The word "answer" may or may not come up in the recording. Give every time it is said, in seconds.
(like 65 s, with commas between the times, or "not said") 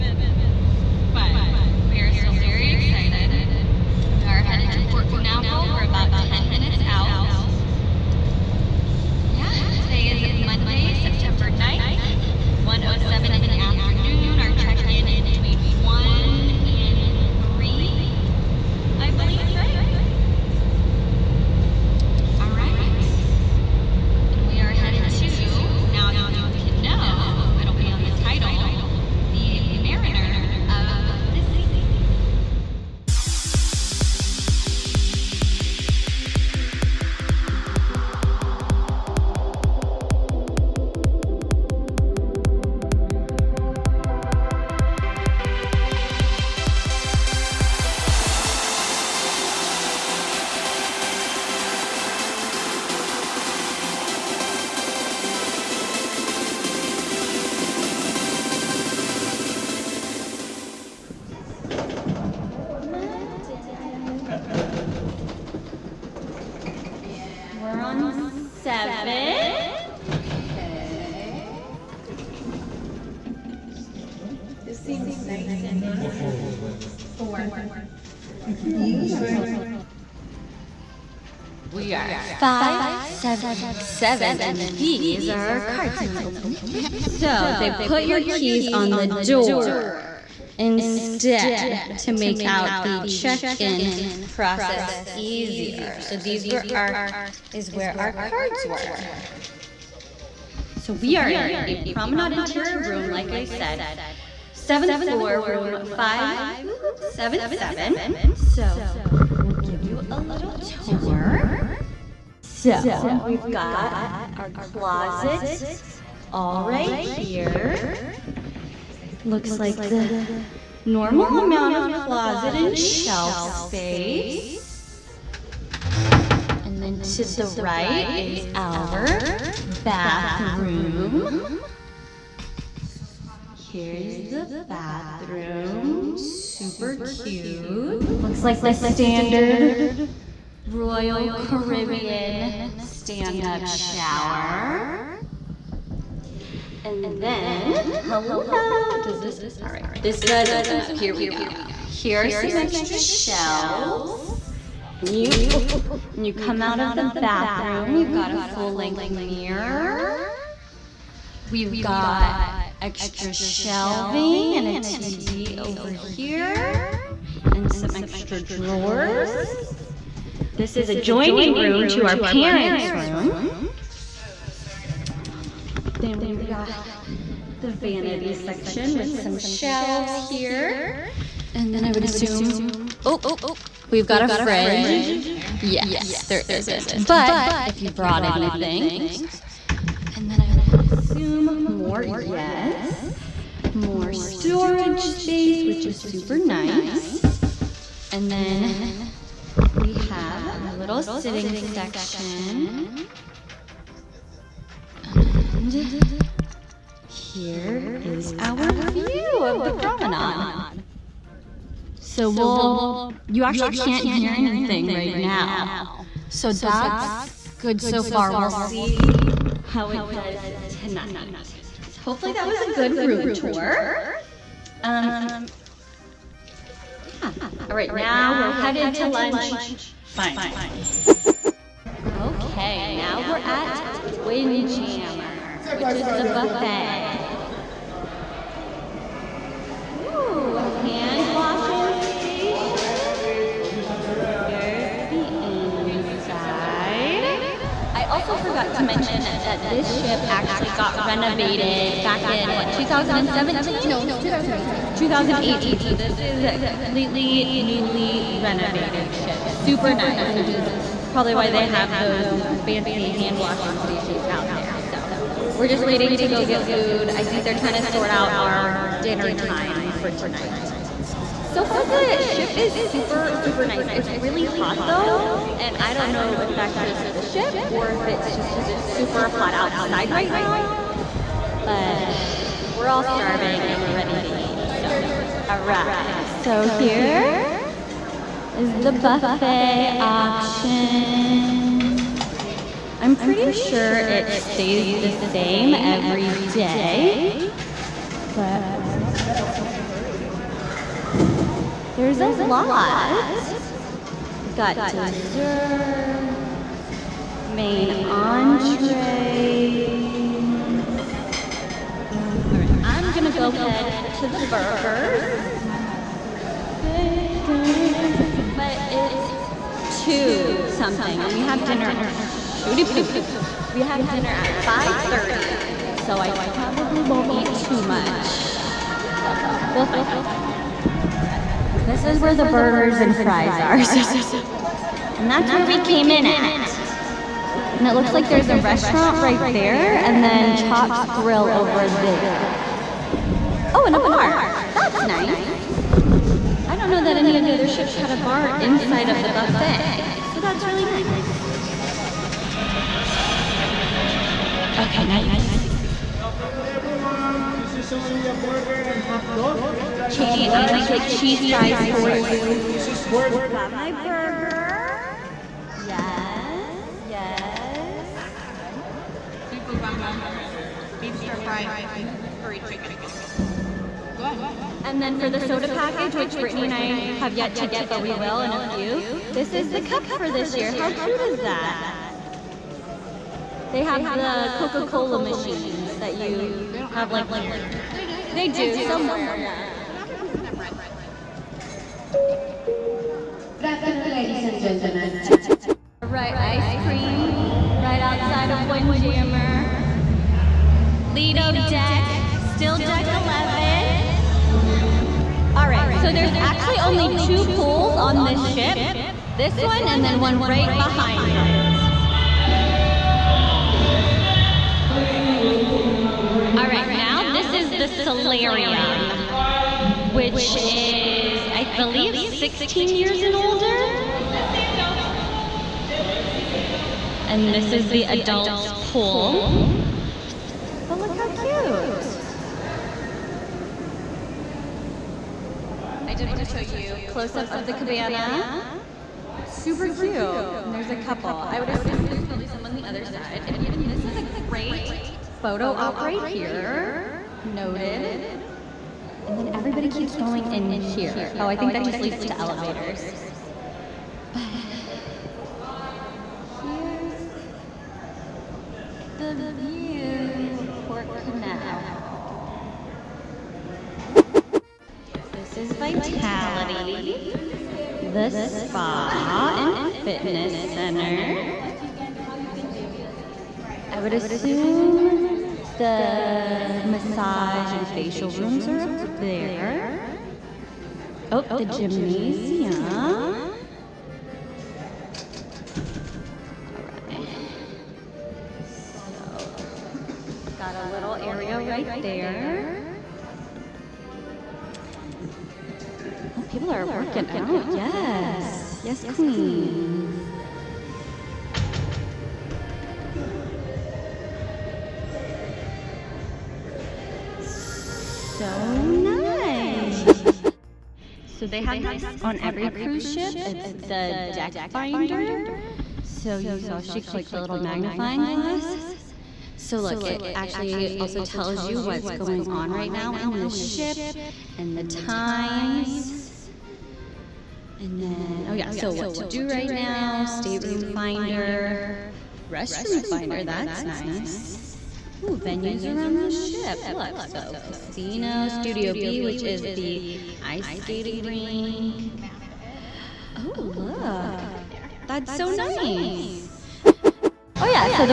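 not said.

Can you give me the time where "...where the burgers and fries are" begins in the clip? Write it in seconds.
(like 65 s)
332 s.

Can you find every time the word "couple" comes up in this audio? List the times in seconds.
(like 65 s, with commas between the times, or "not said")
440 s.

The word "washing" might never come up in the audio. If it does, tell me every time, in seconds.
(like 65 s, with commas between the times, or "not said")
241 s, 263 s.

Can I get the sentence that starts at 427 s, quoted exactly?
And this is the adults pool.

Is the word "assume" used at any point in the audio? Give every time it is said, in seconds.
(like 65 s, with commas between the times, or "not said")
182 s, 190 s, 441 s, 474 s.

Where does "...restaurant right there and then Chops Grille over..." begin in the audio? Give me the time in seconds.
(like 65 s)
338 s.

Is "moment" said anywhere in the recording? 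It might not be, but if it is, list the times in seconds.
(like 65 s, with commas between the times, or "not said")
not said.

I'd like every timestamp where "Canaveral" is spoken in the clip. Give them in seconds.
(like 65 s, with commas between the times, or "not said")
461 s.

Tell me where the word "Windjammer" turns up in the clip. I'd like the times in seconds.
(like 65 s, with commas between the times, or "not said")
234 s, 398 s.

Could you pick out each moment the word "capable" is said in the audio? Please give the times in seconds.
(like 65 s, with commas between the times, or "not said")
not said.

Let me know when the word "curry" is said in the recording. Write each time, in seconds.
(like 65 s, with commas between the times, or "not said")
372 s.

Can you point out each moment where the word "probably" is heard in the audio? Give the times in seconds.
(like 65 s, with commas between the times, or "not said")
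261 s, 326 s, 442 s.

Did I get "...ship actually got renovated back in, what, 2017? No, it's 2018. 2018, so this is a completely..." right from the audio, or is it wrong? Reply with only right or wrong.
right.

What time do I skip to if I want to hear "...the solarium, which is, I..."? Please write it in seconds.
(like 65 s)
417 s.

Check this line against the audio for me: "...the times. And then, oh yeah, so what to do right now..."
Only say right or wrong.
right.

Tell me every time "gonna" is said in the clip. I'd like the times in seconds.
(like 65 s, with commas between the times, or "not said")
313 s, 360 s.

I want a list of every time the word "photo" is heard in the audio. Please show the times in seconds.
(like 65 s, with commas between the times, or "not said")
445 s.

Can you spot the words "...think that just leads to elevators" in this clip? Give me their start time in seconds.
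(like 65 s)
451 s.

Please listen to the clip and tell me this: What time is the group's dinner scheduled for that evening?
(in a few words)
5:30.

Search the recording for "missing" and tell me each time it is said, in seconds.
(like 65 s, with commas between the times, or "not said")
not said.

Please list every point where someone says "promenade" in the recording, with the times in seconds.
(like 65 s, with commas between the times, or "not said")
101 s, 209 s.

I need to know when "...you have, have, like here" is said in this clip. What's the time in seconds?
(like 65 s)
386 s.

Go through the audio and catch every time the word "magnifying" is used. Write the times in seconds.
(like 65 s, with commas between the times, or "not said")
517 s.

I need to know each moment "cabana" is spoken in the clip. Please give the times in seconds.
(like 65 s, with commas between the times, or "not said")
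437 s.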